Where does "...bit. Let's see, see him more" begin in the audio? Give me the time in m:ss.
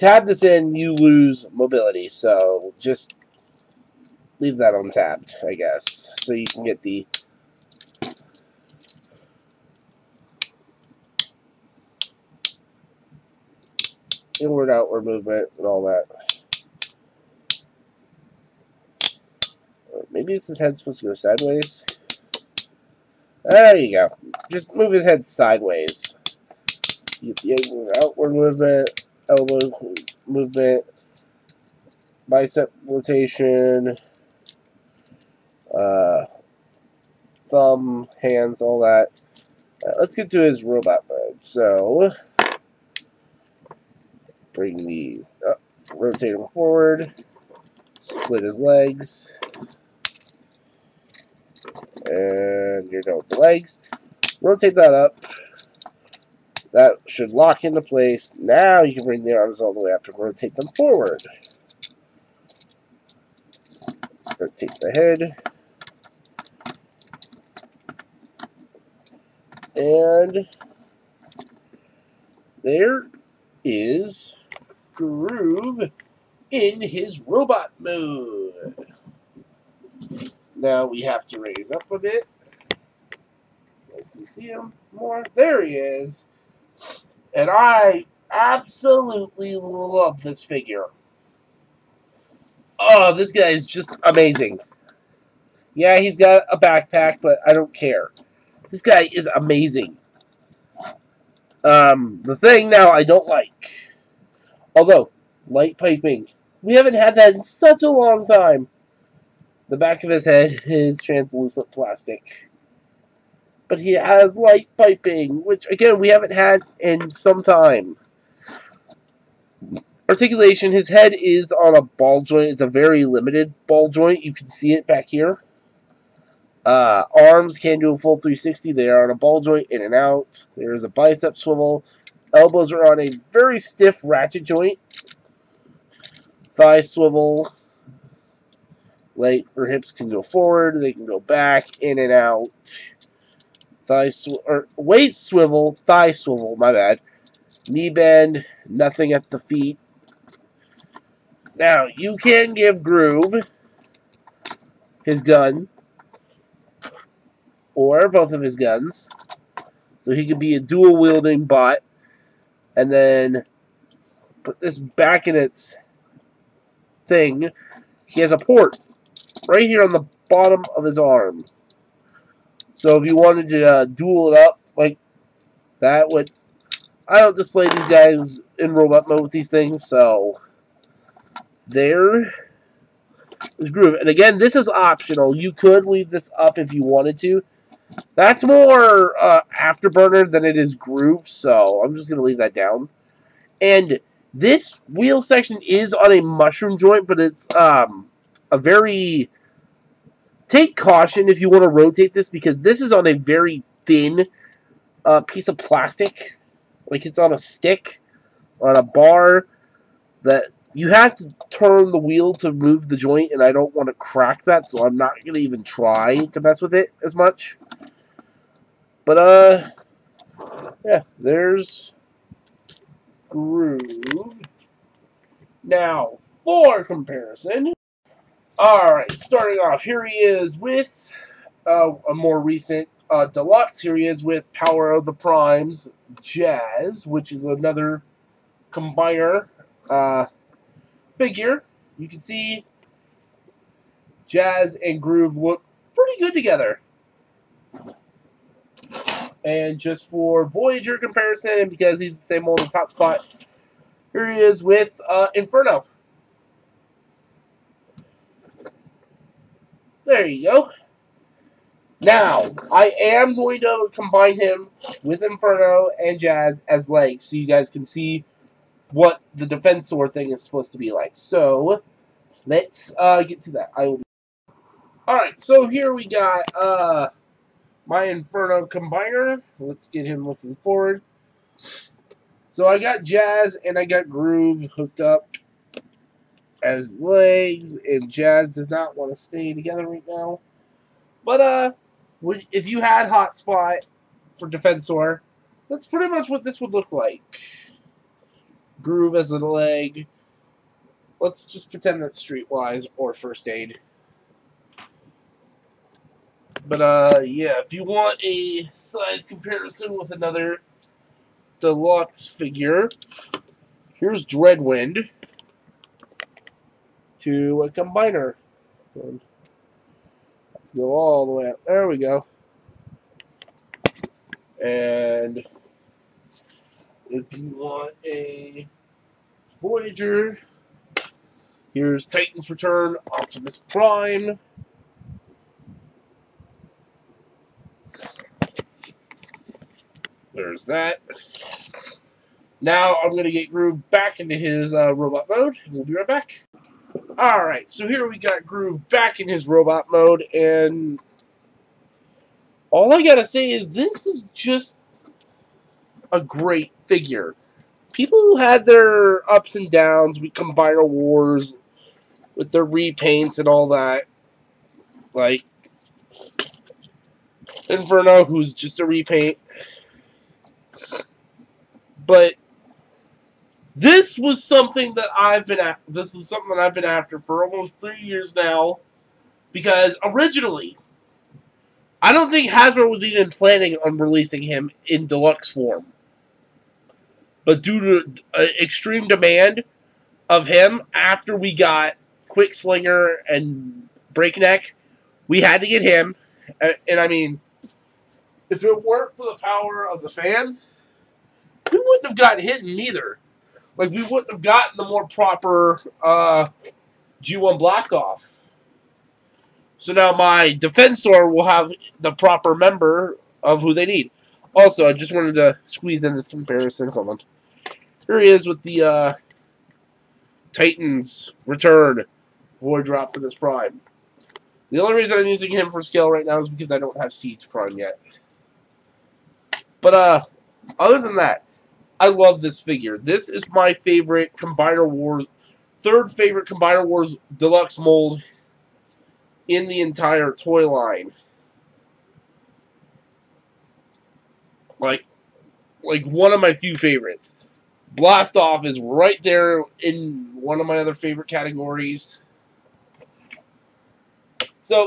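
1:21.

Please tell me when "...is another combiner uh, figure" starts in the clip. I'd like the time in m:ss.
3:57.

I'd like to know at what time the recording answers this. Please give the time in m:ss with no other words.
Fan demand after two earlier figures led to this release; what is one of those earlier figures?
6:32.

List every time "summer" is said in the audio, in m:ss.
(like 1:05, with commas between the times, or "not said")
not said.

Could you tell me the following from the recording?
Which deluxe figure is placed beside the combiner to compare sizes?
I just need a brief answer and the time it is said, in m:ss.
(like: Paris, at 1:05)
Dreadwind, at 5:14.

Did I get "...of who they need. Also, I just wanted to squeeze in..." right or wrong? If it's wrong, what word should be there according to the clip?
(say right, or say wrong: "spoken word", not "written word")
right.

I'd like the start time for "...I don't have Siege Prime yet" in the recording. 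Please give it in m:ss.
7:06.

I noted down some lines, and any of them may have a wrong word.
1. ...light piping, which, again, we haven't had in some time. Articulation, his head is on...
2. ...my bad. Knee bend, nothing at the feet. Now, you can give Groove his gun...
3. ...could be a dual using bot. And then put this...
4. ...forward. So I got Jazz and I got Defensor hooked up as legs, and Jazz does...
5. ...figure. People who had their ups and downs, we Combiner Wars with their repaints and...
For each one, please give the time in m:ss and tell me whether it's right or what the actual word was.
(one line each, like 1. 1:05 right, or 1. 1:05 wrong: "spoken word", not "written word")
1. 1:54 right
2. 2:26 right
3. 2:40 wrong: "wielding", not "using"
4. 4:40 wrong: "Groove", not "Defensor"
5. 5:56 right.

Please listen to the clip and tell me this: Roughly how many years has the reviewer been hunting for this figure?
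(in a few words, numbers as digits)
3 years.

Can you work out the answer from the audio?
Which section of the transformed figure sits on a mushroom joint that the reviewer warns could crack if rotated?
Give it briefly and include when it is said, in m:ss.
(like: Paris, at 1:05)
wheel section, at 3:14.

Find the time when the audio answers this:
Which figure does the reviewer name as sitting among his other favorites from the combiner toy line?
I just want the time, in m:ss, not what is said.
7:27.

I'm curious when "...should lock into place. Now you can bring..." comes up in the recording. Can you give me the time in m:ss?
0:57.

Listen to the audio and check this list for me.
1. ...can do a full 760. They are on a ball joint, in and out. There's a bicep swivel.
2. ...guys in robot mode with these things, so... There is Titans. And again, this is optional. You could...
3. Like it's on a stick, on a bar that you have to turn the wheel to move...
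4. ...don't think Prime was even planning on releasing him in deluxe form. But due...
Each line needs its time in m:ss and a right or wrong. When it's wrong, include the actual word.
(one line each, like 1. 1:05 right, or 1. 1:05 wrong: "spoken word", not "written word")
1. 2:07 wrong: "360", not "760"
2. 2:57 wrong: "Groove", not "Titans"
3. 3:26 right
4. 6:22 wrong: "Hasbro", not "Prime".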